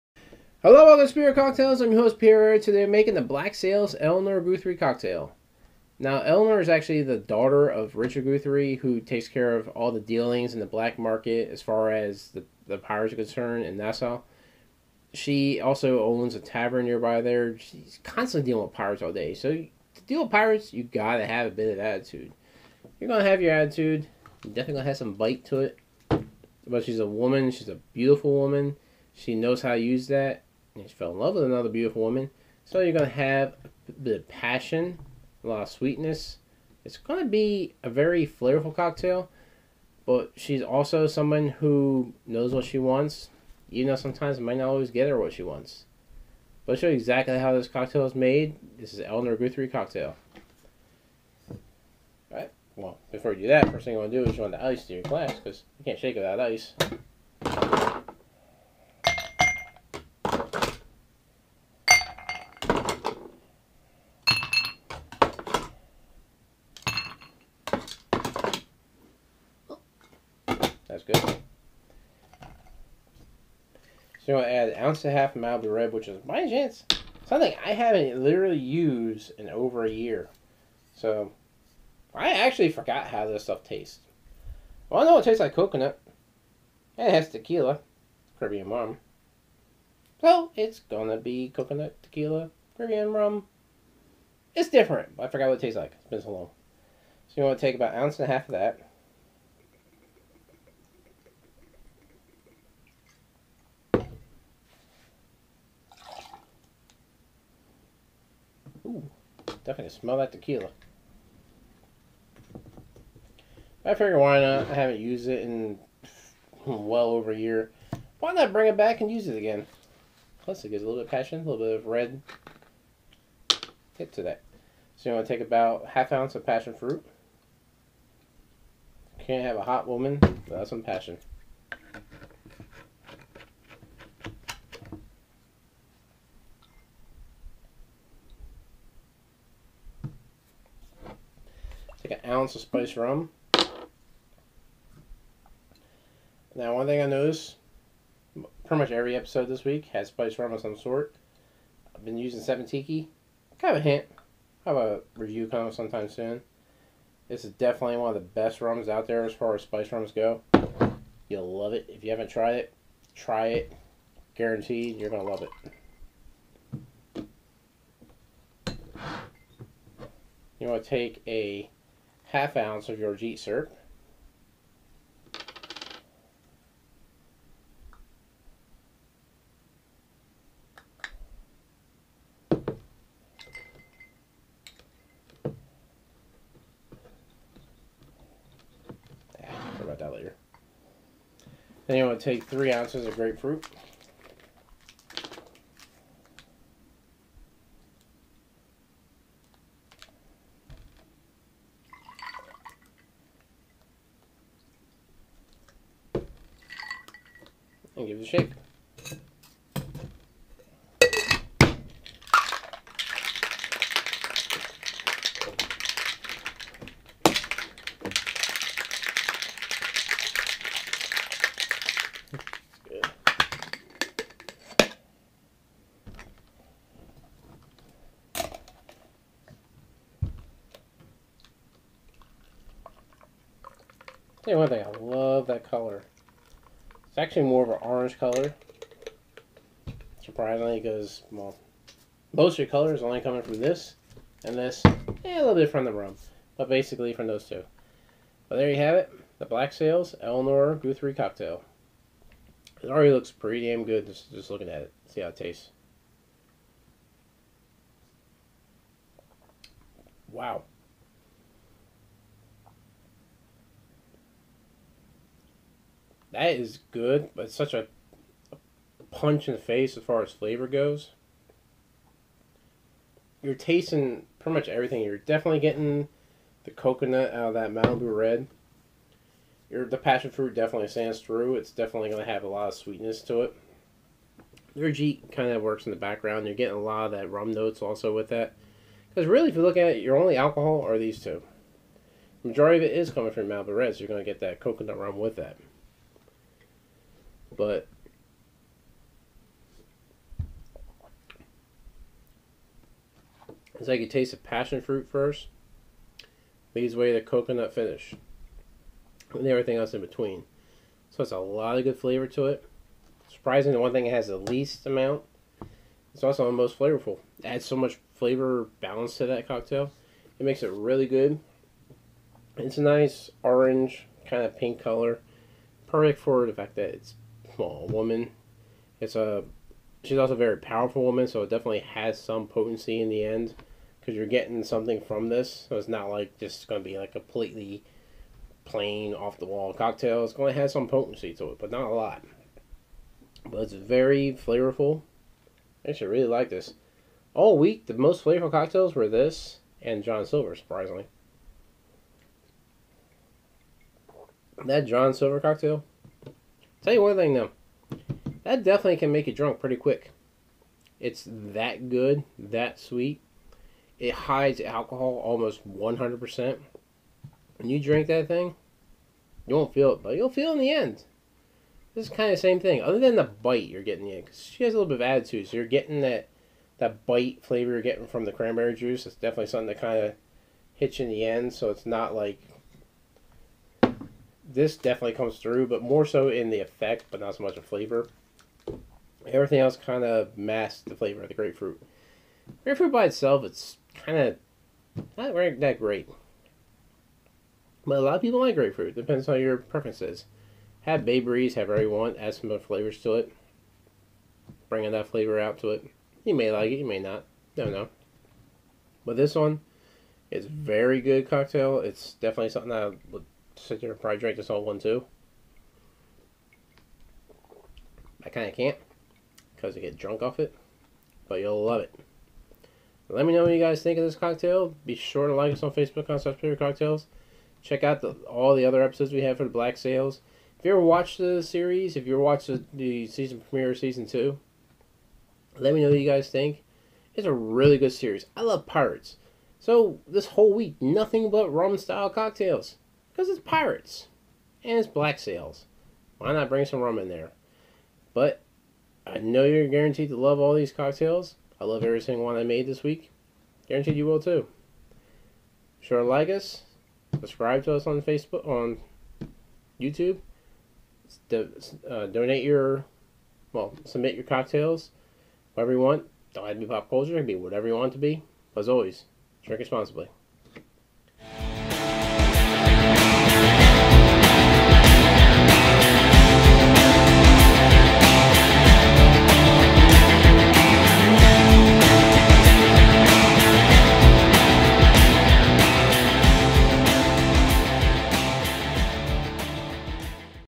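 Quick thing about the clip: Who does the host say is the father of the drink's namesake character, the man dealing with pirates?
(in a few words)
Richard Guthrie.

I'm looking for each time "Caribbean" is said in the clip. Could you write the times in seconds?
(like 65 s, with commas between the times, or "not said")
88 s, 92 s.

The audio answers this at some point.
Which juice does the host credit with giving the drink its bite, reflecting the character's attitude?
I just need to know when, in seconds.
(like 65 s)
378 s.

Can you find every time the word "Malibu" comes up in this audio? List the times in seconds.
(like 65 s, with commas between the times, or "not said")
75 s, 277 s, 293 s.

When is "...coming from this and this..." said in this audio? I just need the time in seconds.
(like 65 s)
243 s.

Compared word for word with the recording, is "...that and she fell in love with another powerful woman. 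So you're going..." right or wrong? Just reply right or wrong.
wrong.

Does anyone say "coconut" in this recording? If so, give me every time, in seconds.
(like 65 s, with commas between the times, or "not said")
85 s, 91 s, 276 s, 294 s, 307 s.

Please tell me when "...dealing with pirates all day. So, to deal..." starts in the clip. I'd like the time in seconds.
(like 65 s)
18 s.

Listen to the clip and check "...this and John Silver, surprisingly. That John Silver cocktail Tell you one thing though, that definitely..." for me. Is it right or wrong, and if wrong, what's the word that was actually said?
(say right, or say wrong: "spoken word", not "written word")
right.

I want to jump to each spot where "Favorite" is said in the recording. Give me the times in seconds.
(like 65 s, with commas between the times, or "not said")
426 s.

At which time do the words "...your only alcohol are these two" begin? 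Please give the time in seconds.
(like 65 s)
290 s.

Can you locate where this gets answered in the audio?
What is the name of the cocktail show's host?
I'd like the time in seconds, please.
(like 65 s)
2 s.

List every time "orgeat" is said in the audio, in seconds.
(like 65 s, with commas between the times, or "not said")
173 s, 284 s.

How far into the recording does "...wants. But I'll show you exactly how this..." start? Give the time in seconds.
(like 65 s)
45 s.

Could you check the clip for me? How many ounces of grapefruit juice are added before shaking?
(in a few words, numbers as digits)
3 ounces.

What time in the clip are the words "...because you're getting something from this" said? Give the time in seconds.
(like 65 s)
333 s.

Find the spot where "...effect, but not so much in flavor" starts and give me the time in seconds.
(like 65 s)
386 s.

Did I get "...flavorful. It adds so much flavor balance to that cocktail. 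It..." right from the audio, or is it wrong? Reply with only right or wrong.
right.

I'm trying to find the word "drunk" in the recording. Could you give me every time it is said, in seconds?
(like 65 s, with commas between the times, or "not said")
359 s, 419 s.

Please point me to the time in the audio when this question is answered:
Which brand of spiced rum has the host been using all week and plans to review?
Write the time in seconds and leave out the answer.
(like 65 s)
152 s.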